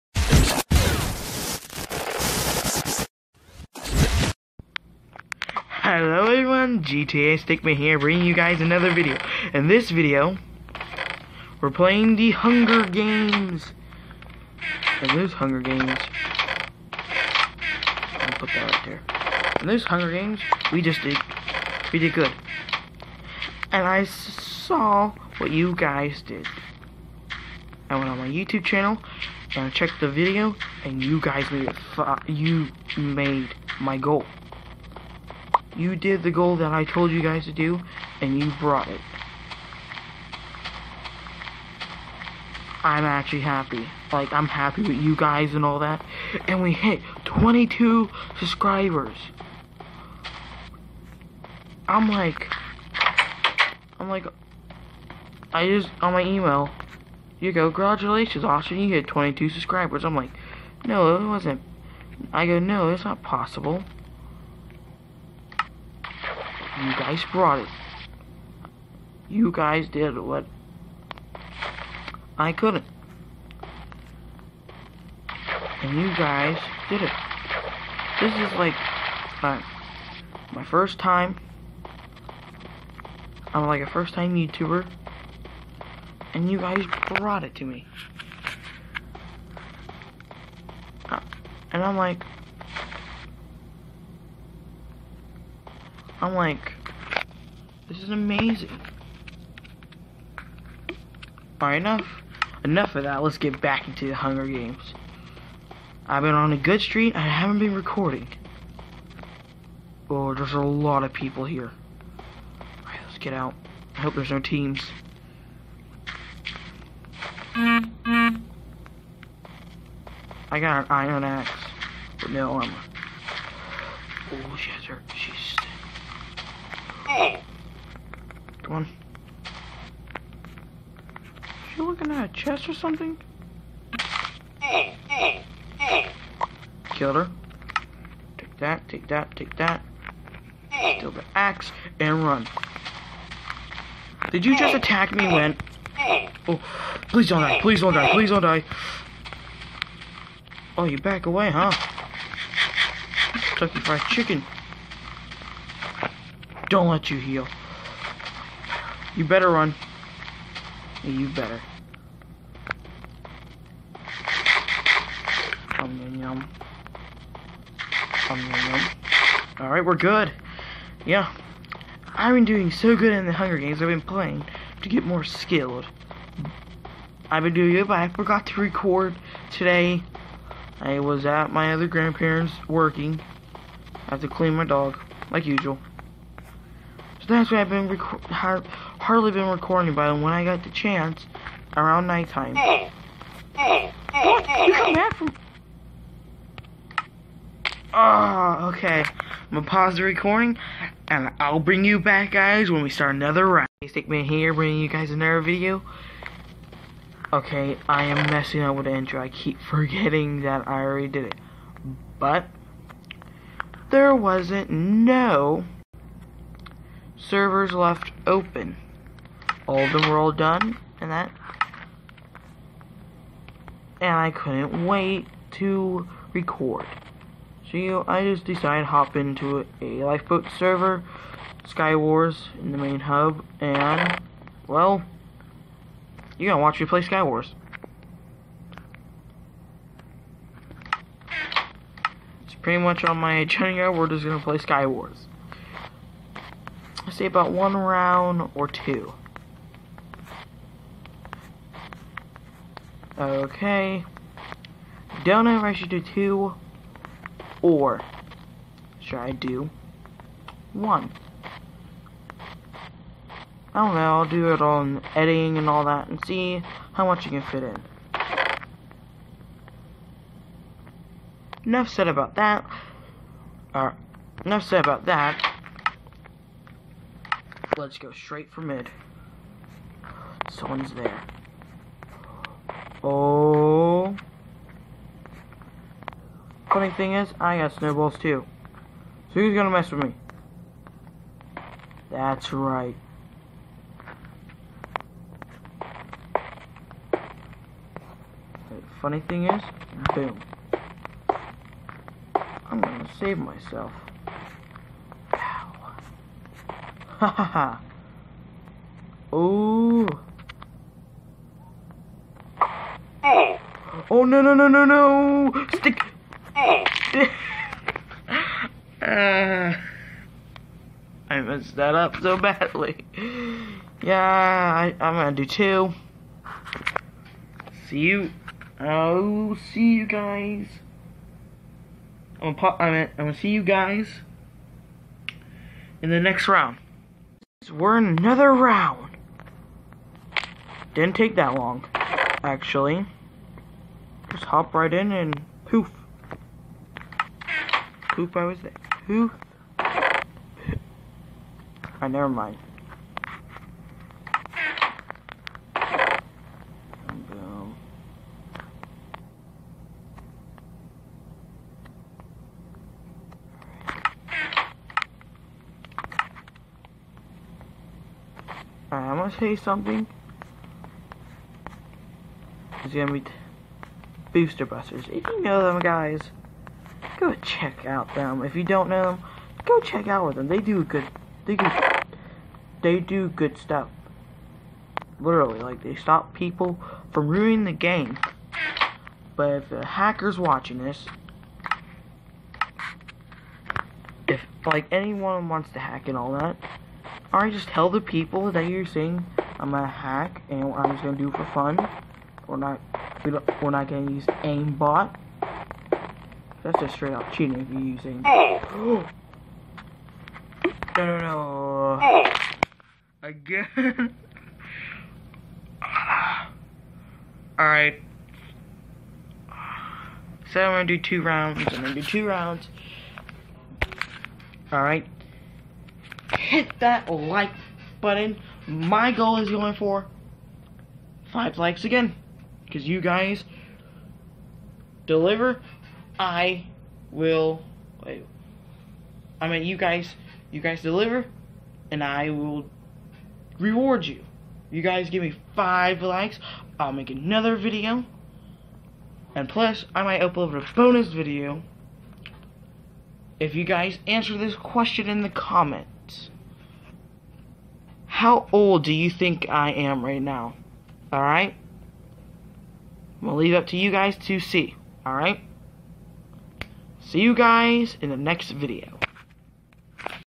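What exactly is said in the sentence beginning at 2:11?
You looking at a chest or something?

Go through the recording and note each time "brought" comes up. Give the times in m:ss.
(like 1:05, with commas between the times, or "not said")
0:38, 1:07, 1:27.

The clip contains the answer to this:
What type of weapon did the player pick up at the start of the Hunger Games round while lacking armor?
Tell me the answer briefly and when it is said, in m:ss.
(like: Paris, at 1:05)
iron axe, at 2:00.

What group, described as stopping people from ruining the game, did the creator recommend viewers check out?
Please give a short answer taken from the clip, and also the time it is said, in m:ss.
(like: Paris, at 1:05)
Booster Busters, at 6:14.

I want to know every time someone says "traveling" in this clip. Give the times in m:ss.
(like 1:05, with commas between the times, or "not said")
not said.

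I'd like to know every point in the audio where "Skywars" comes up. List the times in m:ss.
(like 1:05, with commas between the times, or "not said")
3:51, 3:57, 4:04.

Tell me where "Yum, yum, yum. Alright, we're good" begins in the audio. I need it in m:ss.
2:45.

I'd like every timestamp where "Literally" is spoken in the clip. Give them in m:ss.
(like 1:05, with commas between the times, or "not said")
6:25.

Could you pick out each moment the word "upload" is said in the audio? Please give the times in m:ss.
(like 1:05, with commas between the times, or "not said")
7:30.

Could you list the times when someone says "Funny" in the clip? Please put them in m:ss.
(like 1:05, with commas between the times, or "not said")
4:46, 4:59.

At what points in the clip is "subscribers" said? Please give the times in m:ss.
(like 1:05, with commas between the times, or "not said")
0:48, 0:59.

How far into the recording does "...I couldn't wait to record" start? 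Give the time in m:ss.
3:44.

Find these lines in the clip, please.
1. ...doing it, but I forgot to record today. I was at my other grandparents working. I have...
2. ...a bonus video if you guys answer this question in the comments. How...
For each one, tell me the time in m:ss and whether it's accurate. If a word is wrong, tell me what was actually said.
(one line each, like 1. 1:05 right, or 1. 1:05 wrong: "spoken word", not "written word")
1. 2:57 right
2. 7:30 right.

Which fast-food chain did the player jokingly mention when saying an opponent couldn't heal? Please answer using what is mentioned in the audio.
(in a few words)
Kentucky Fried Chicken.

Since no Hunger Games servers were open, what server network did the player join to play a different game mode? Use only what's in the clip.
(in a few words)
Lifeboat.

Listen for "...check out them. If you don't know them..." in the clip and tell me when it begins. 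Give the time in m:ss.
6:17.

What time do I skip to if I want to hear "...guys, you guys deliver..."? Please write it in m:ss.
7:19.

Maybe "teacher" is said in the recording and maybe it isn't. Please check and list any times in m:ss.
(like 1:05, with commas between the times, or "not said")
not said.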